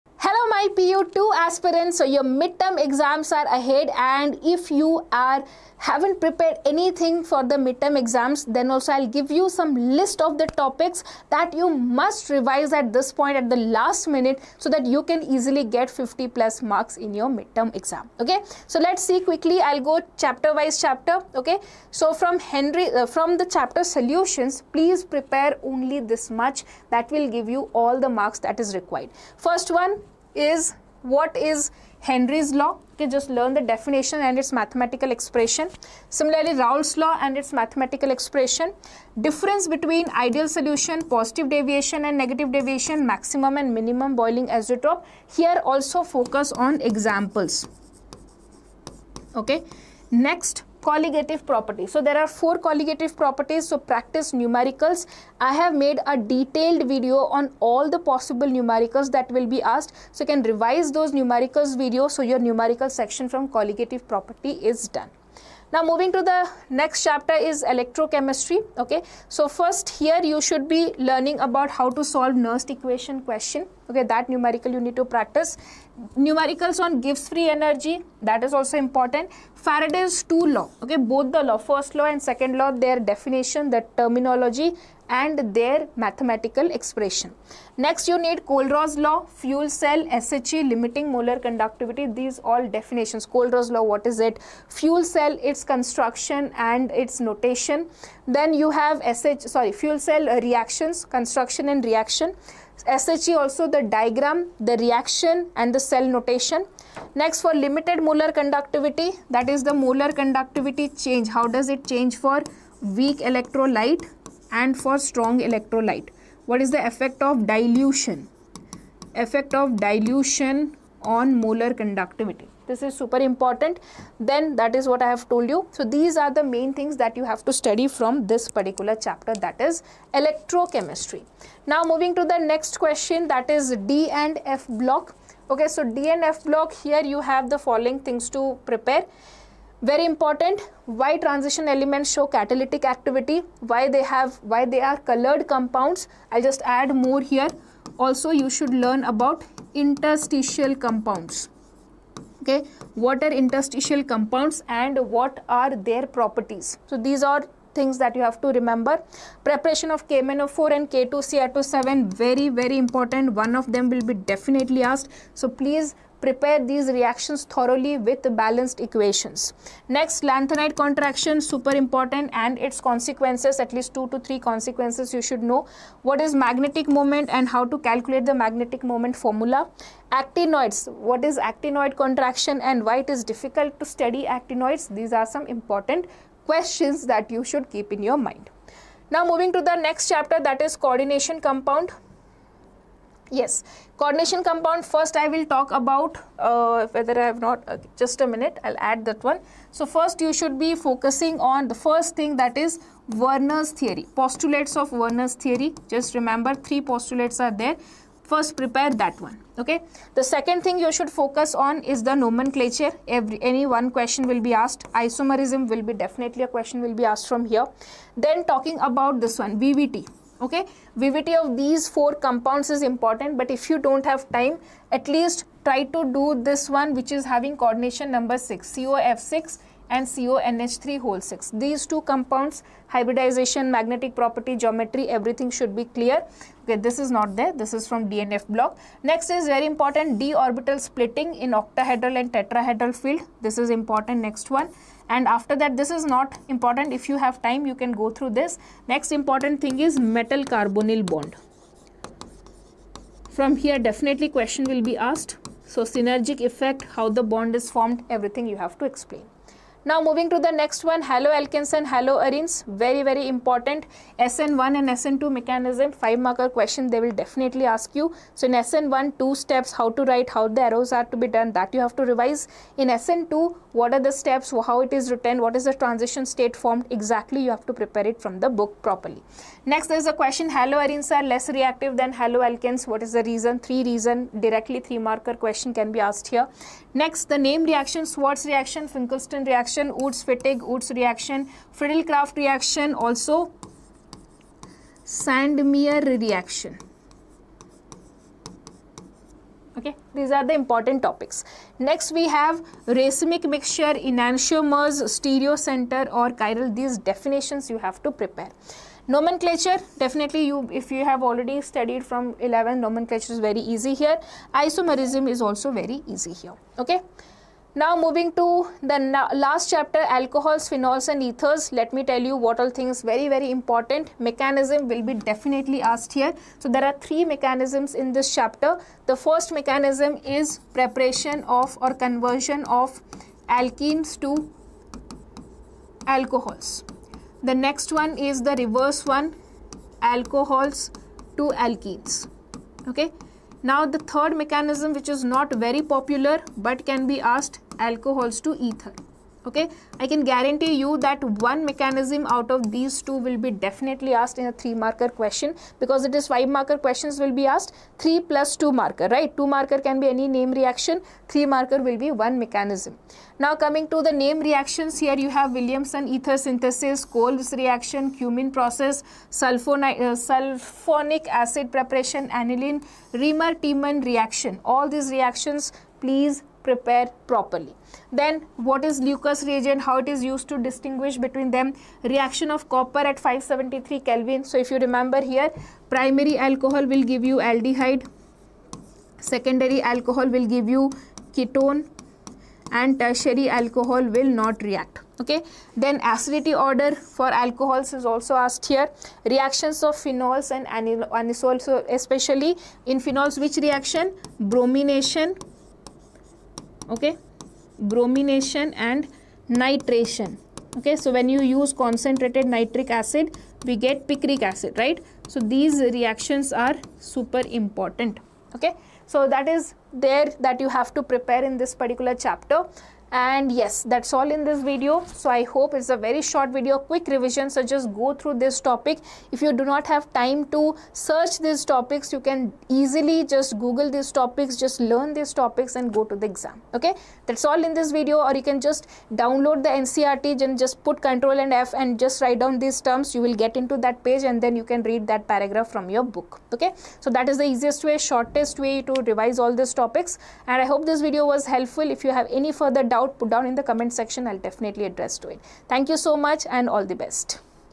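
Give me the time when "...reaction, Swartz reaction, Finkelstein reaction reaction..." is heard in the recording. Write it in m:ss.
4:47.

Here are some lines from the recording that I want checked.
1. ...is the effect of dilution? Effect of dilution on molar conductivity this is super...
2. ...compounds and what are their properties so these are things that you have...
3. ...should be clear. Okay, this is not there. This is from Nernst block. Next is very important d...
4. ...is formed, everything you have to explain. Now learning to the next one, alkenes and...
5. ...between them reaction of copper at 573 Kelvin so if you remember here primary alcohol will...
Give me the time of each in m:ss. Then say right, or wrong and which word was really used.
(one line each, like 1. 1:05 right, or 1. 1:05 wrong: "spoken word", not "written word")
1. 1:56 right
2. 2:34 right
3. 3:55 wrong: "DNF", not "Nernst"
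4. 4:17 wrong: "moving", not "learning"
5. 6:21 right.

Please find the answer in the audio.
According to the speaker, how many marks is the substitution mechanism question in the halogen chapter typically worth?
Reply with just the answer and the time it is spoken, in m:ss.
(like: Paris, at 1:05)
5, at 4:25.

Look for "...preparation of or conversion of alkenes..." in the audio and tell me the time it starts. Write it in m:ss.
5:30.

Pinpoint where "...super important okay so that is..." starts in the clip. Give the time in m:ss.
6:57.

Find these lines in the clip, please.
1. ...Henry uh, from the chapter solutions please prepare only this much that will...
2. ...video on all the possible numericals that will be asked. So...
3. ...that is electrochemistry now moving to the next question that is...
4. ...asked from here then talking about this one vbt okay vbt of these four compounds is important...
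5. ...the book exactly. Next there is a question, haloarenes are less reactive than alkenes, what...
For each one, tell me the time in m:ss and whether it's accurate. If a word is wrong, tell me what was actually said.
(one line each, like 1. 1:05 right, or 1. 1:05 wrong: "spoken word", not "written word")
1. 0:22 right
2. 0:56 right
3. 2:09 right
4. 3:37 right
5. 4:38 wrong: "properly", not "exactly".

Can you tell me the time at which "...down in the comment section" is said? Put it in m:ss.
7:33.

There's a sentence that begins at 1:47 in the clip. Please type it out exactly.
Next for limited molar conductivity that is the molar conductivity change.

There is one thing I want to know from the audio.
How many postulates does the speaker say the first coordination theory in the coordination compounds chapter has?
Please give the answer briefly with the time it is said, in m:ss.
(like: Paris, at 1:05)
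3, at 3:26.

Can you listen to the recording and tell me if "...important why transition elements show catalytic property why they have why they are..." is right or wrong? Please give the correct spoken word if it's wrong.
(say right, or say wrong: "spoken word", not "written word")
wrong: "activity", not "property".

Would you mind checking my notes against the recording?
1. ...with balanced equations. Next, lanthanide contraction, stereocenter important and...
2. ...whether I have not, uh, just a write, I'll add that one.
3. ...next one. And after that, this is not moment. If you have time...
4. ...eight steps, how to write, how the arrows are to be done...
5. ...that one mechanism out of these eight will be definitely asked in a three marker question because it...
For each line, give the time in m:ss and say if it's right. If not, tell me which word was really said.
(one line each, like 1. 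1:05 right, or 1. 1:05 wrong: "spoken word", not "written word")
1. 2:47 wrong: "super", not "stereocenter"
2. 3:16 wrong: "minute", not "write"
3. 4:04 wrong: "important", not "moment"
4. 4:29 wrong: "two", not "eight"
5. 5:51 wrong: "two", not "eight".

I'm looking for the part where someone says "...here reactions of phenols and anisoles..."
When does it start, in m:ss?
6:38.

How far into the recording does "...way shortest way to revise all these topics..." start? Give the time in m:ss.
7:27.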